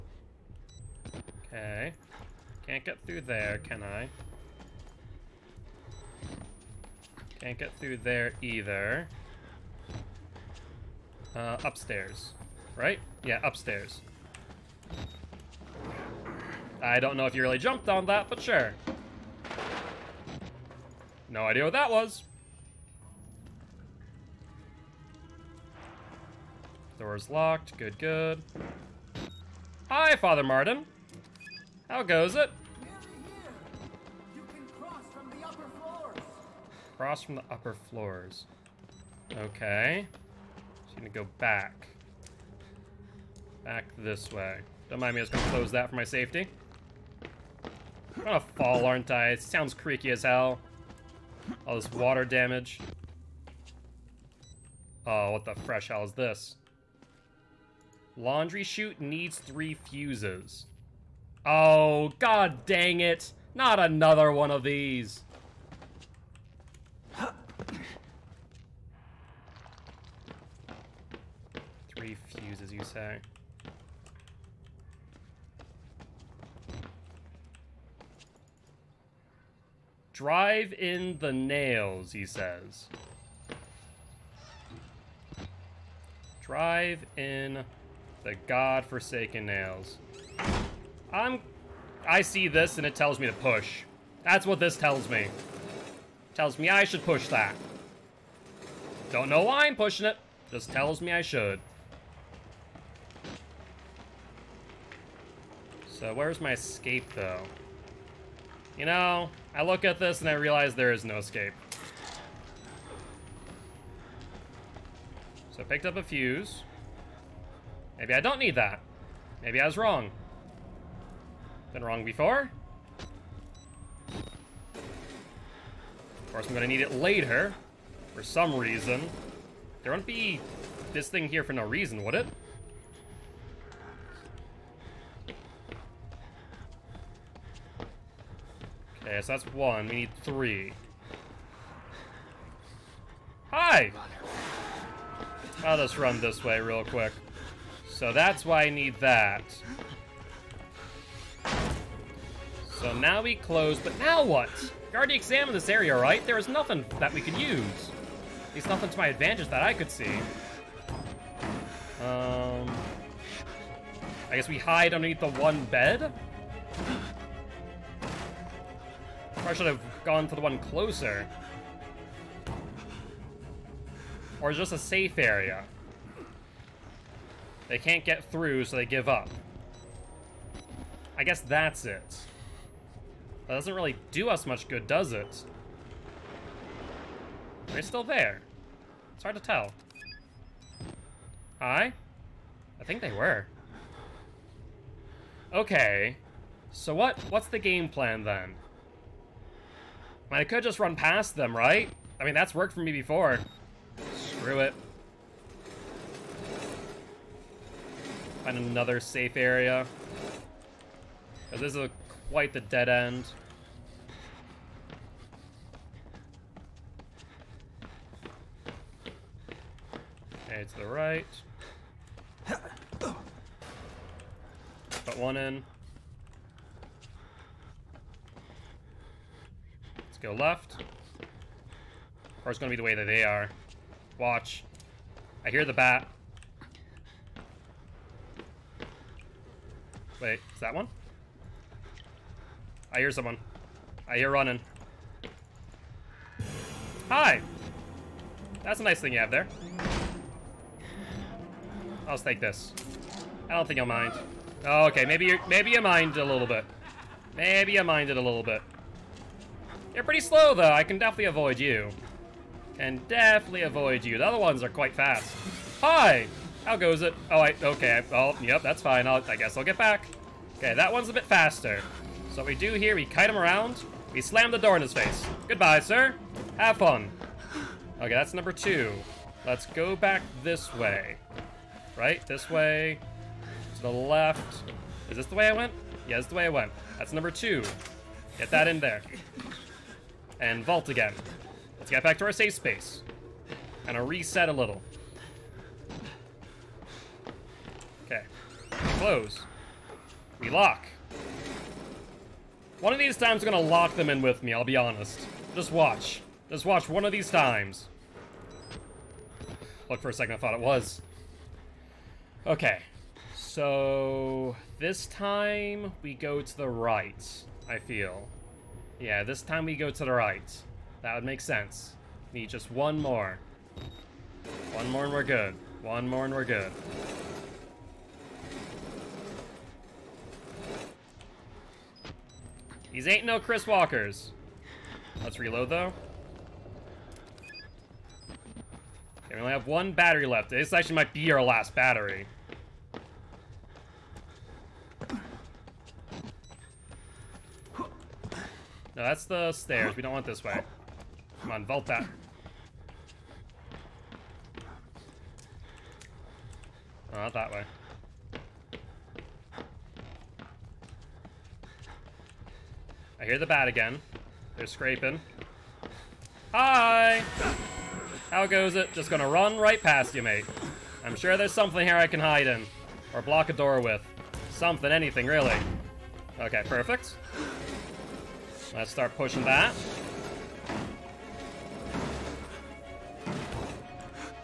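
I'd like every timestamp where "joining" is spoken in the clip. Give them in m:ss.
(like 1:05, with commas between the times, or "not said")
not said.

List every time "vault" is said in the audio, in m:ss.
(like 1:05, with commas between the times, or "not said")
4:50, 5:51.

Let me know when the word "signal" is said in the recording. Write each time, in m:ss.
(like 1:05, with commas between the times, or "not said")
not said.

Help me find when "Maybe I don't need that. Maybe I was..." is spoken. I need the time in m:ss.
1:57.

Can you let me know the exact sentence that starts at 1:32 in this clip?
I see this and it tells me to push.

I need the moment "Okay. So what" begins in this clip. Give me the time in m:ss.
3:15.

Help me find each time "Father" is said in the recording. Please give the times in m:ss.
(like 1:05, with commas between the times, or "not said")
0:30.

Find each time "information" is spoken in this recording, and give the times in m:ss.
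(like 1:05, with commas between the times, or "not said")
not said.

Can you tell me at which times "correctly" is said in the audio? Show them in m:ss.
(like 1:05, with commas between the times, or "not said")
not said.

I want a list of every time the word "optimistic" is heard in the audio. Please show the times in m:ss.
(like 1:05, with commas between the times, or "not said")
not said.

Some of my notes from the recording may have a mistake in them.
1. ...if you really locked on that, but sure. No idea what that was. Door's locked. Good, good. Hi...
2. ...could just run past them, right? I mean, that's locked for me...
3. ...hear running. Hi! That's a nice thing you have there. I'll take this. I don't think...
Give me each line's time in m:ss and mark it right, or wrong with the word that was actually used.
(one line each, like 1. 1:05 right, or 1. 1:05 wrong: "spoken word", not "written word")
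1. 0:17 wrong: "jumped", not "locked"
2. 3:20 wrong: "worked", not "locked"
3. 4:04 right.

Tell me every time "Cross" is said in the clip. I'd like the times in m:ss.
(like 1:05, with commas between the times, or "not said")
0:36.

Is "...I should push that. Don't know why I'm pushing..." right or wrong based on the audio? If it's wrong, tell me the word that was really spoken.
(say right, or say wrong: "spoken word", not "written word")
right.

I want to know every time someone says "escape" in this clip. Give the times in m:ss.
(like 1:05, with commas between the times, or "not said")
1:46, 1:51.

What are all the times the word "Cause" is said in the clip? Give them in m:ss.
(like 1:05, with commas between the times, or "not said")
3:31.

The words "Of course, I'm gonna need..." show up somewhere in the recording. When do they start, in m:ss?
2:04.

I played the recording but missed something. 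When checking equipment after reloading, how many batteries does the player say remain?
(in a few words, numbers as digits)
1.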